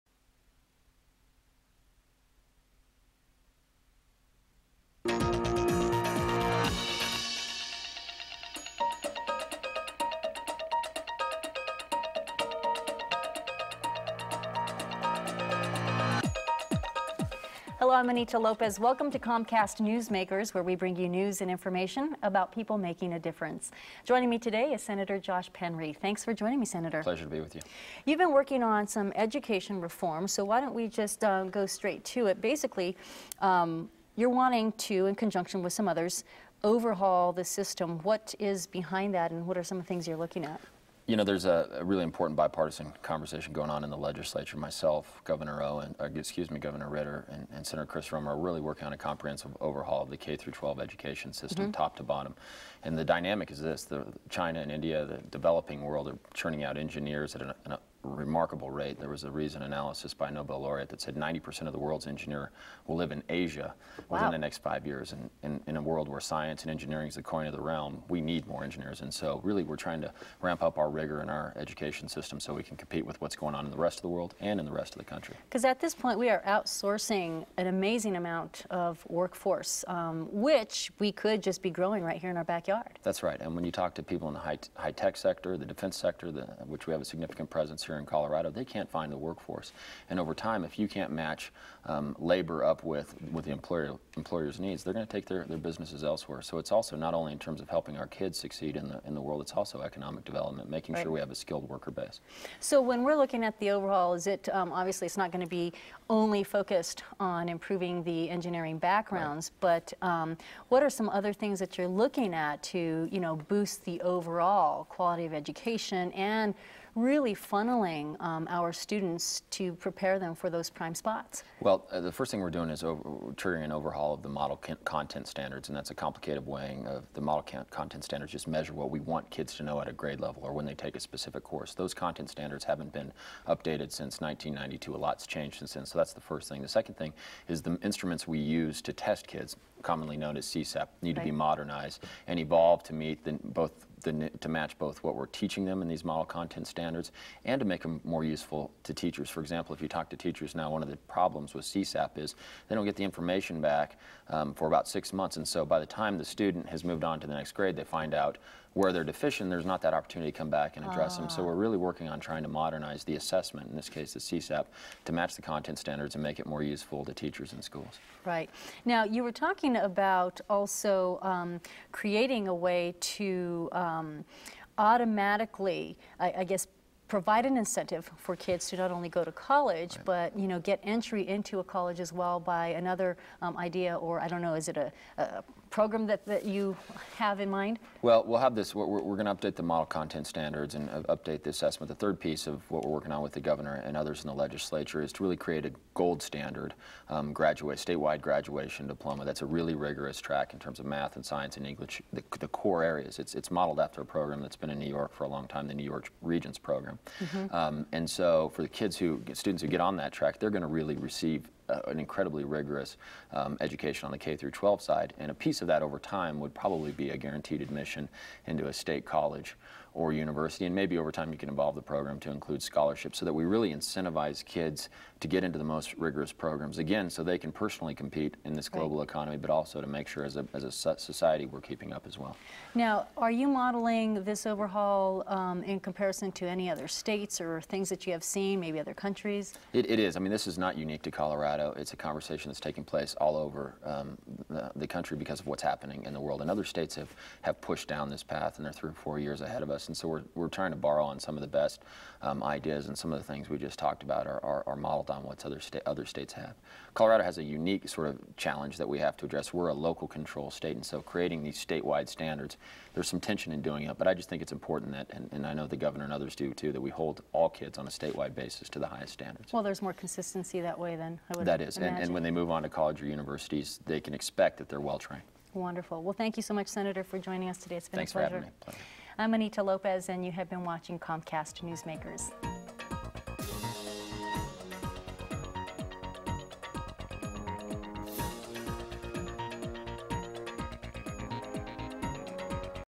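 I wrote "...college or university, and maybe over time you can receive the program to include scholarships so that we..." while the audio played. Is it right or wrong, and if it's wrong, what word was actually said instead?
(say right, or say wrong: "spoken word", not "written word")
wrong: "evolve", not "receive".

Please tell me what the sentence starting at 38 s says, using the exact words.
What is behind that, and what are some of the things you're looking at?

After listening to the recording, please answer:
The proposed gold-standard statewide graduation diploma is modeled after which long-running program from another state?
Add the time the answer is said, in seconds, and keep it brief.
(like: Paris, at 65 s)
New York Regents program, at 205 s.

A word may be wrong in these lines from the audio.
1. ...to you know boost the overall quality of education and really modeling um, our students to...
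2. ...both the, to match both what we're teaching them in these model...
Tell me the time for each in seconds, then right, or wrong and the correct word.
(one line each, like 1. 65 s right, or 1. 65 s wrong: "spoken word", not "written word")
1. 112 s wrong: "funneling", not "modeling"
2. 143 s right.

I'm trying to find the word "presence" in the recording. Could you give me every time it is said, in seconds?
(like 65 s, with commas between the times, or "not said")
87 s.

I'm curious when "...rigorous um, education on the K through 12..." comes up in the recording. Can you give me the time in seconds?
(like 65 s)
212 s.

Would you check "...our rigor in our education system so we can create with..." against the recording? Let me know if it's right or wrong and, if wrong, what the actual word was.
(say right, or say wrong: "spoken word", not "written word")
wrong: "compete", not "create".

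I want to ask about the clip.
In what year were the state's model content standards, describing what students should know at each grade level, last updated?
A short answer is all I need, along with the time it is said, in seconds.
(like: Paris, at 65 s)
1992, at 134 s.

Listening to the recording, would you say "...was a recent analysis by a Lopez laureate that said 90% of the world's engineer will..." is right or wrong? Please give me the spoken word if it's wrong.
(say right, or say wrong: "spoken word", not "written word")
wrong: "Nobel", not "Lopez".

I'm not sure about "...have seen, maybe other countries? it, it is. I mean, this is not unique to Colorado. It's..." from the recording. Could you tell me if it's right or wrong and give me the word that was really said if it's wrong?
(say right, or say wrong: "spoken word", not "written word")
right.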